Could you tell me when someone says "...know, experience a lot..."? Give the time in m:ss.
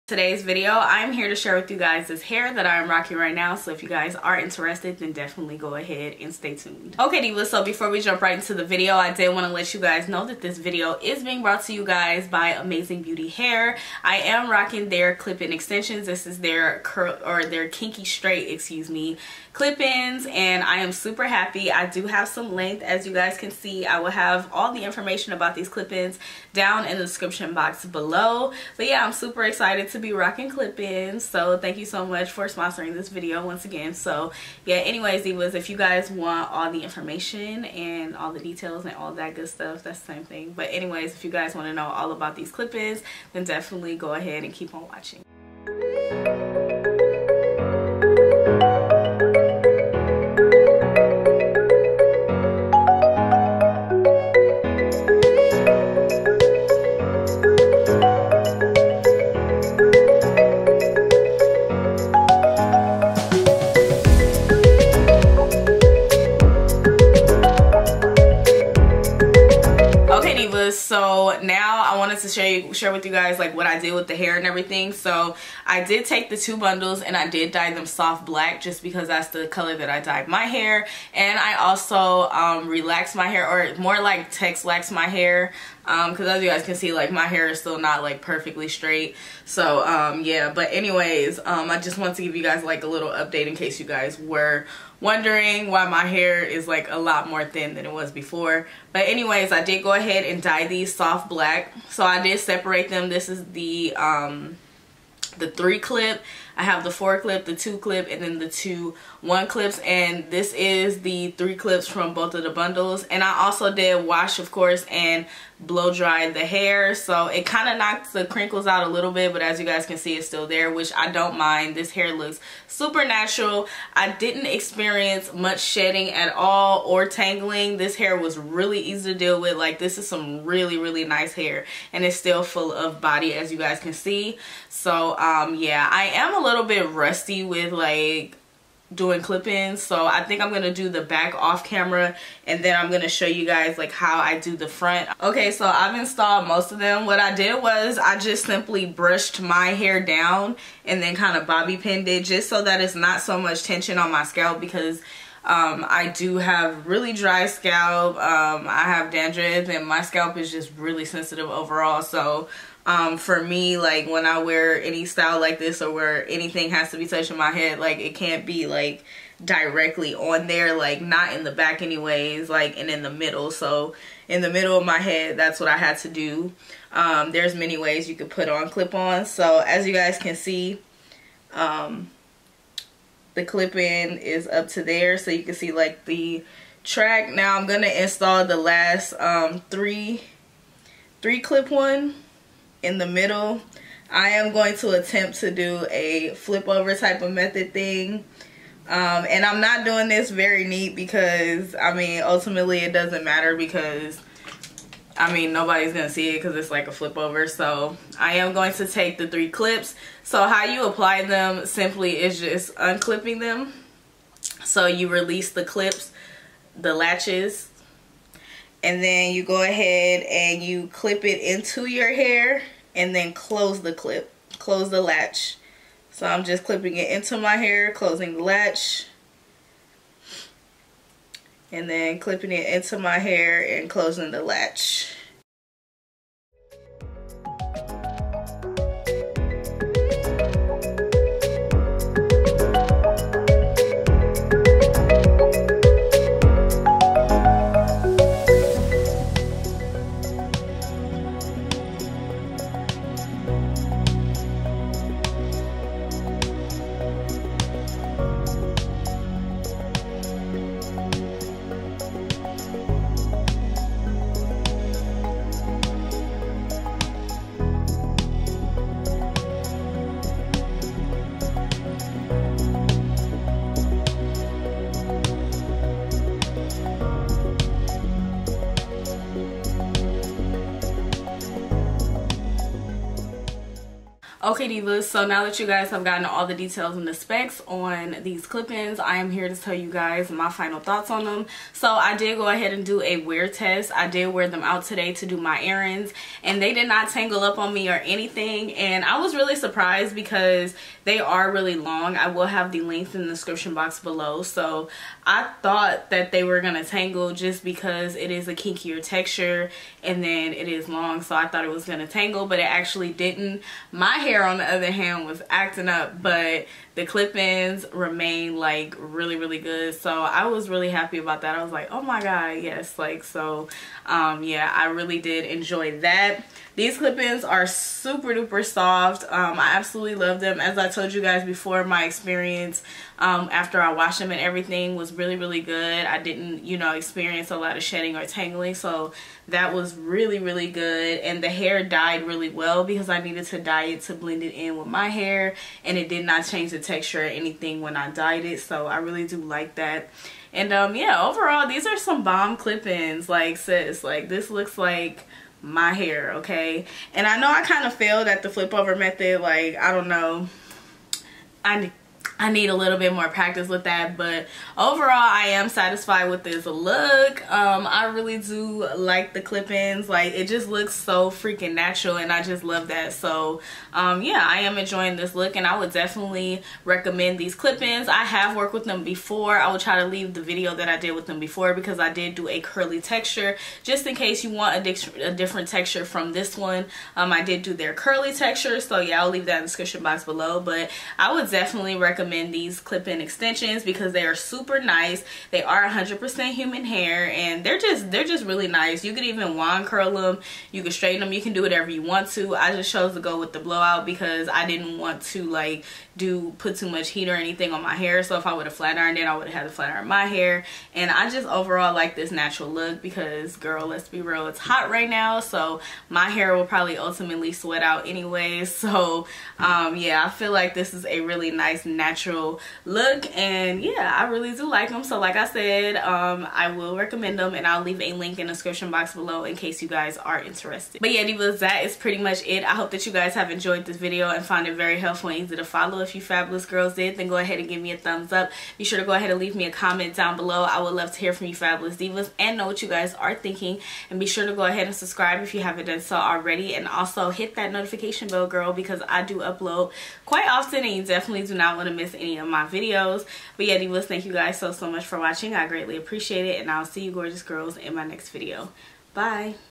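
5:36.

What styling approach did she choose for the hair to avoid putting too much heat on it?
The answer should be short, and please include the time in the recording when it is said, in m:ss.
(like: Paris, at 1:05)
blowout, at 6:43.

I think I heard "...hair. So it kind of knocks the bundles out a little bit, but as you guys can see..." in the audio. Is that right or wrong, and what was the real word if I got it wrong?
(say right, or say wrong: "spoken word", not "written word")
wrong: "crinkles", not "bundles".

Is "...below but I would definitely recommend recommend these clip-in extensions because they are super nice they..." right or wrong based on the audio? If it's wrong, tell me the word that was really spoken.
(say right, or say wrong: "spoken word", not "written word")
right.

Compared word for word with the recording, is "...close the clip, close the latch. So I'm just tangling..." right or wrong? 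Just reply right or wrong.
wrong.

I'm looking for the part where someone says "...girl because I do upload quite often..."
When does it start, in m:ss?
7:28.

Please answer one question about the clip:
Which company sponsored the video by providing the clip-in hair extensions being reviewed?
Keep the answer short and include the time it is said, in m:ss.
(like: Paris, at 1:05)
Amazing Beauty Hair, at 0:12.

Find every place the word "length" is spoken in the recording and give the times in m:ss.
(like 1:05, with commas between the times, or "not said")
0:22, 5:02.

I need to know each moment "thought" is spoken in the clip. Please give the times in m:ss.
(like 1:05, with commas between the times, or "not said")
4:50, 5:05, 5:11.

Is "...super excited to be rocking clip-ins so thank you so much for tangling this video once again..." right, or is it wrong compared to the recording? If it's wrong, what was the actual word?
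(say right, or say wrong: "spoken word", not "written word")
wrong: "sponsoring", not "tangling".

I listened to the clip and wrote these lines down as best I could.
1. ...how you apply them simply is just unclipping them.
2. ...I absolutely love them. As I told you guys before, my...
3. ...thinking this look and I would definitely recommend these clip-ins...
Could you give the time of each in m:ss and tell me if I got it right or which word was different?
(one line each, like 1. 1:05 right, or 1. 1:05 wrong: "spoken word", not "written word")
1. 3:30 right
2. 5:29 right
3. 6:14 wrong: "enjoying", not "thinking".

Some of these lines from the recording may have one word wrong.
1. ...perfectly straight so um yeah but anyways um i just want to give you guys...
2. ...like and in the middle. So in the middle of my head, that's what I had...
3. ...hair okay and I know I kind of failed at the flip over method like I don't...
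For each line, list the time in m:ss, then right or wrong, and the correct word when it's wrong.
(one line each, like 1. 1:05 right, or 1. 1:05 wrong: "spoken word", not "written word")
1. 1:28 right
2. 2:52 right
3. 5:55 right.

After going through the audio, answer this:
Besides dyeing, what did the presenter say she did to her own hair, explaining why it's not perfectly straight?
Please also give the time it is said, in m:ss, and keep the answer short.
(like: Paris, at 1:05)
texlax, at 1:24.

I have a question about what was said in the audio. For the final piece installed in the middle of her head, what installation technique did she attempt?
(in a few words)
flip over method.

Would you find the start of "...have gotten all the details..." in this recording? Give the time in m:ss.
4:45.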